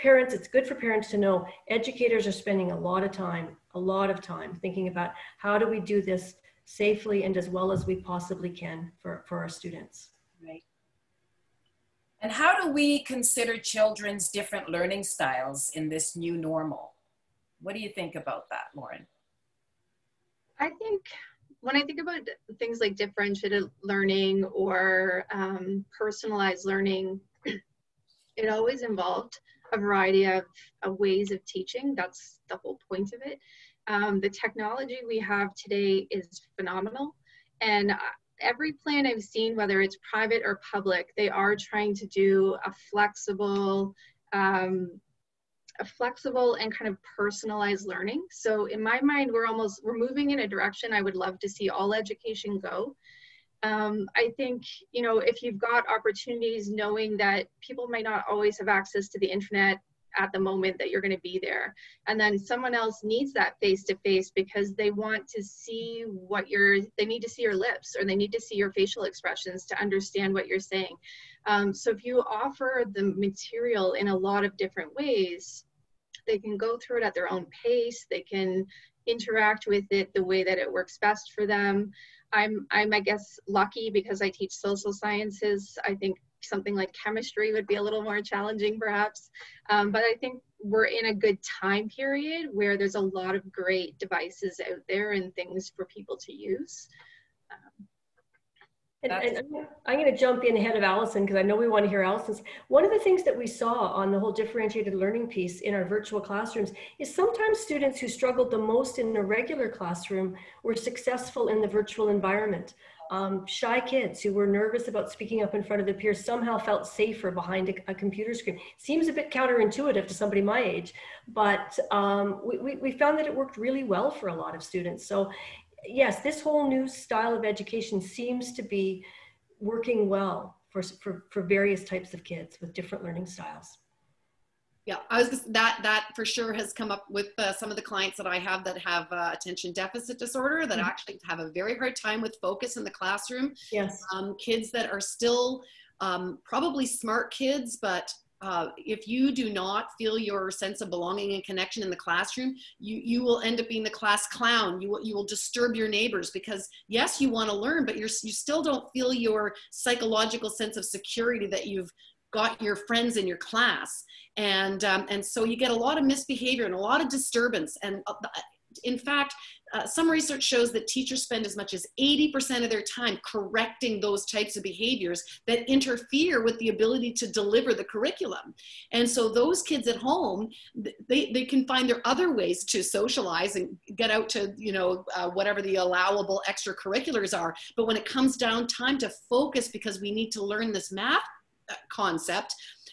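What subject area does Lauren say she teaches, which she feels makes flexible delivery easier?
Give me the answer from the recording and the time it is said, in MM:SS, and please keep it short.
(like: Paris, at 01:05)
social sciences, at 01:24.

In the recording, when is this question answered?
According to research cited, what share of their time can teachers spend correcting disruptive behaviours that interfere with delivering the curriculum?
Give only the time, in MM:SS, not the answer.
02:52.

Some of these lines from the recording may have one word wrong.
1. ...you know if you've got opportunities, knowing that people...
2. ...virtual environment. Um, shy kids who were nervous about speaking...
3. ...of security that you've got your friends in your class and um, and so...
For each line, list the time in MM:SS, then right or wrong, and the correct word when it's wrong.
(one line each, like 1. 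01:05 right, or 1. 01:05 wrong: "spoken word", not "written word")
1. 00:54 right
2. 01:51 right
3. 02:40 right.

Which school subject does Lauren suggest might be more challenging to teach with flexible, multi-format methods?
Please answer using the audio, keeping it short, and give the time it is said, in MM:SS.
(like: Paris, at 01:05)
chemistry, at 01:26.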